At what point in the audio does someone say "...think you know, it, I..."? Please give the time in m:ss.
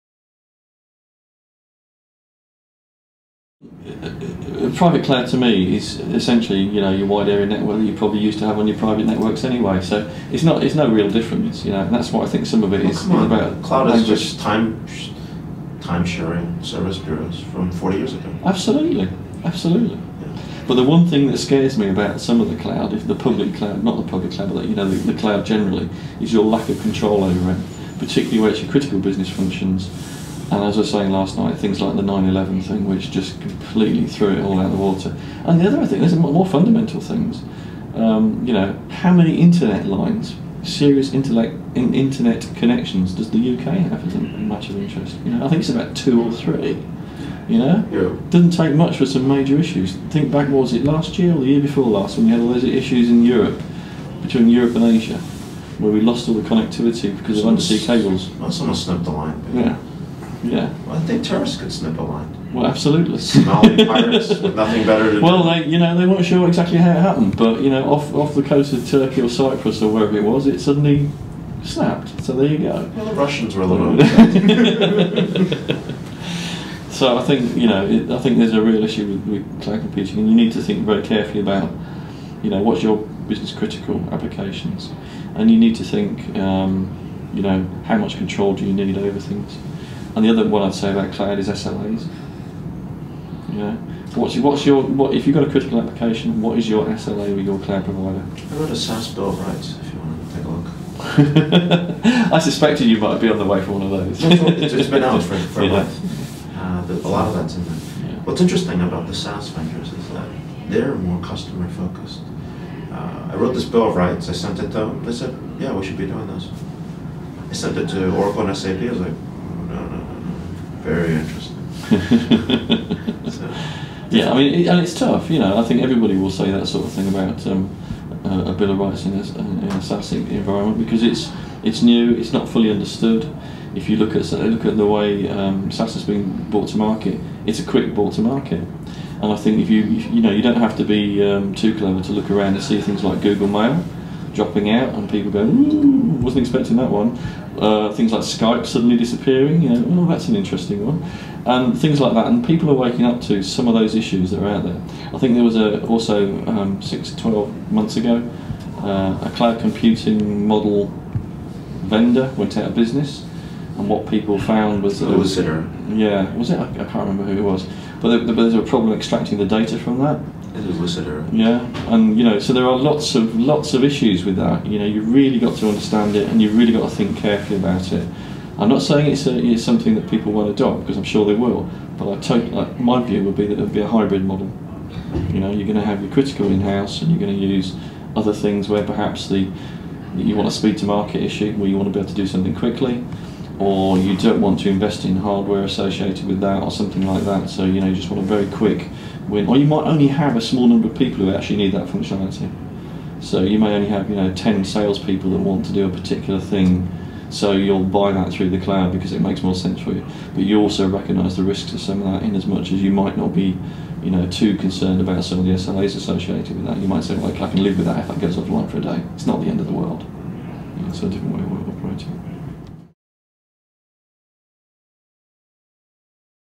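1:17.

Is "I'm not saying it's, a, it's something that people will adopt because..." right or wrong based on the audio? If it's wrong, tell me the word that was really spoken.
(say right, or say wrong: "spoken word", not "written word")
right.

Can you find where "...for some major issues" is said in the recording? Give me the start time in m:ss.
0:48.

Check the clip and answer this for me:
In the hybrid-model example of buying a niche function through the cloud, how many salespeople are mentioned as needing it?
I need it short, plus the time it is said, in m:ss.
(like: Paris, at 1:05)
10, at 3:24.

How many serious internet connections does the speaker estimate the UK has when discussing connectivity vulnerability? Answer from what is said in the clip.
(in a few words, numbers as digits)
2 or 3.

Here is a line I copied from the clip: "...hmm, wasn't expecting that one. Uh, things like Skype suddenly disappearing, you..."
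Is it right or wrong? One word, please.
right.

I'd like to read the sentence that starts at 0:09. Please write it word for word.
So it's not it's no real difference, you know.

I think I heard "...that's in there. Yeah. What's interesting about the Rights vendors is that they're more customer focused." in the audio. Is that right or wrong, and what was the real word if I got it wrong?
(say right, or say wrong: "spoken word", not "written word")
wrong: "SaaS", not "Rights".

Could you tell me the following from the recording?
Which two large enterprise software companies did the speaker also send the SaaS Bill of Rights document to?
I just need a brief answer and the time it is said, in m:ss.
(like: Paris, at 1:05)
Oracle and SAP, at 1:58.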